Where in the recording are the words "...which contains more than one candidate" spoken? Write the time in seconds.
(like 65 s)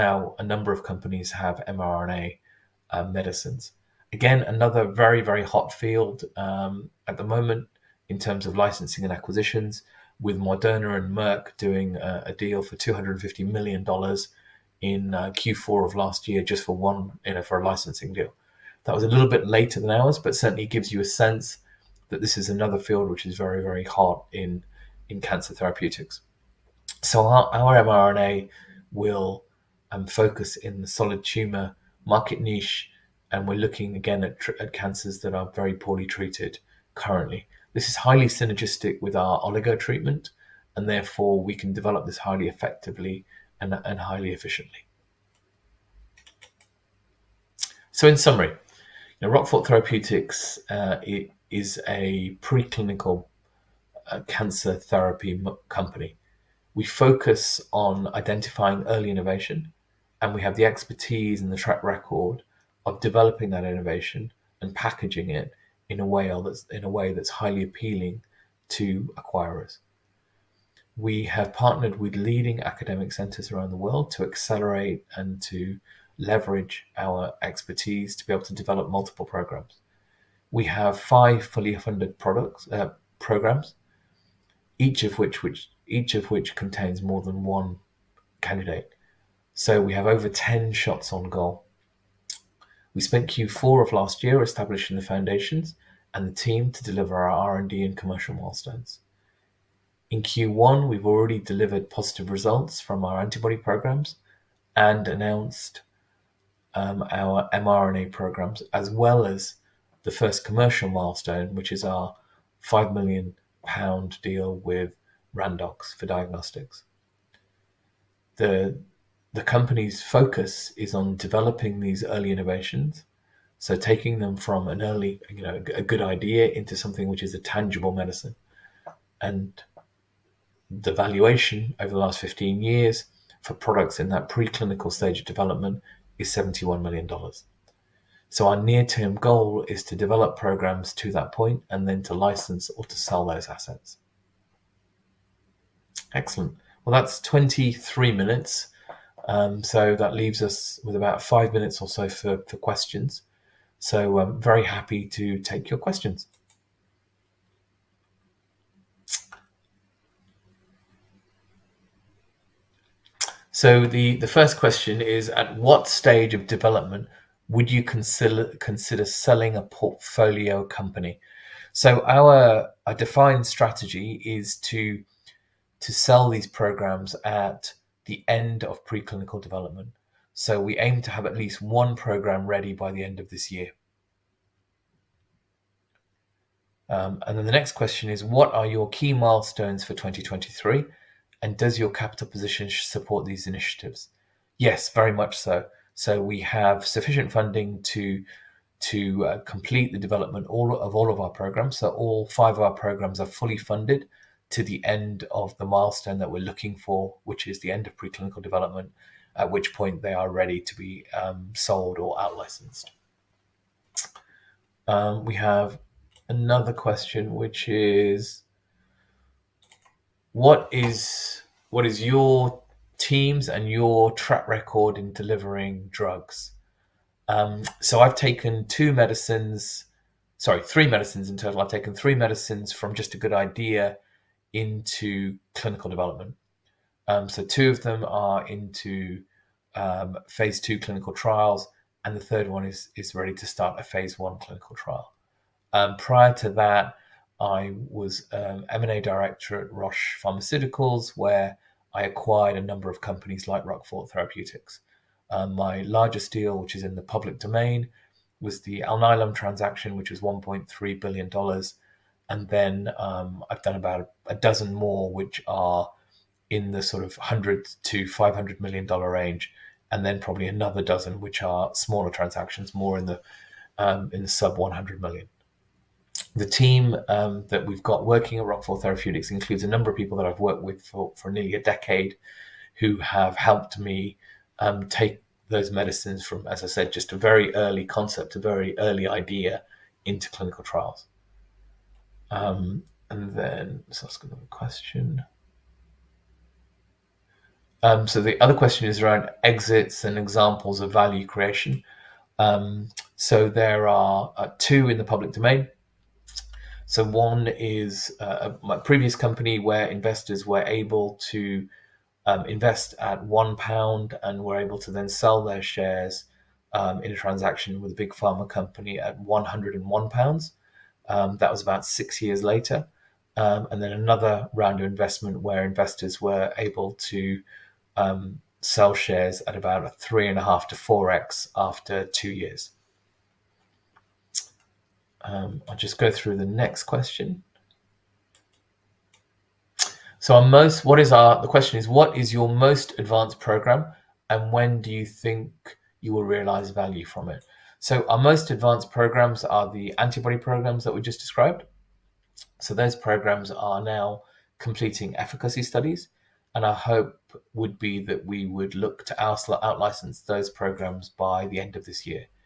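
86 s.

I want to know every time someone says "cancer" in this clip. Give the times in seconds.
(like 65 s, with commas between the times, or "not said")
25 s, 34 s, 54 s.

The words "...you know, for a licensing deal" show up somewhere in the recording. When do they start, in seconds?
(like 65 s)
17 s.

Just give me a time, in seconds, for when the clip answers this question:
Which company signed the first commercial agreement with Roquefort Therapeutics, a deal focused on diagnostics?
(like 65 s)
115 s.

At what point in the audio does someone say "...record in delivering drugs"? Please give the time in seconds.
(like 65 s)
224 s.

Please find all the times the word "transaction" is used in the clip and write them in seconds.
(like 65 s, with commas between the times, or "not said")
259 s, 272 s, 317 s.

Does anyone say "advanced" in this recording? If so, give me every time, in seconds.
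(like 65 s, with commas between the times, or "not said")
342 s, 348 s.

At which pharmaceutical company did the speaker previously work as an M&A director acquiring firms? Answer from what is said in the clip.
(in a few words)
Roche.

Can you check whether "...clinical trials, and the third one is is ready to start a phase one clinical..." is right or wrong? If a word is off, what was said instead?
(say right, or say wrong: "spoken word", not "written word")
right.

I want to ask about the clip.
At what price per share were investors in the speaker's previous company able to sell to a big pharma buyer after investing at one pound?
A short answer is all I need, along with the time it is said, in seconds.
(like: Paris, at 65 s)
101 pounds, at 319 s.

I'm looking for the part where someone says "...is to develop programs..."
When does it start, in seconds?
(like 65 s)
139 s.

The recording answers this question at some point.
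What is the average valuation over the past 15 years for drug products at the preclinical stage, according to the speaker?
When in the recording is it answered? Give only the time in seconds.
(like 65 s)
136 s.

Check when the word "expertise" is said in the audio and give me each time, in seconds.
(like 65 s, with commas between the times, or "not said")
60 s, 77 s.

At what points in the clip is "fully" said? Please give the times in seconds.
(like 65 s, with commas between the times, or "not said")
81 s, 203 s.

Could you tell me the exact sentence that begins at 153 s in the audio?
So I'm um, very happy to take your questions.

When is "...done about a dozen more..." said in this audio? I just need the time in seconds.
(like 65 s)
263 s.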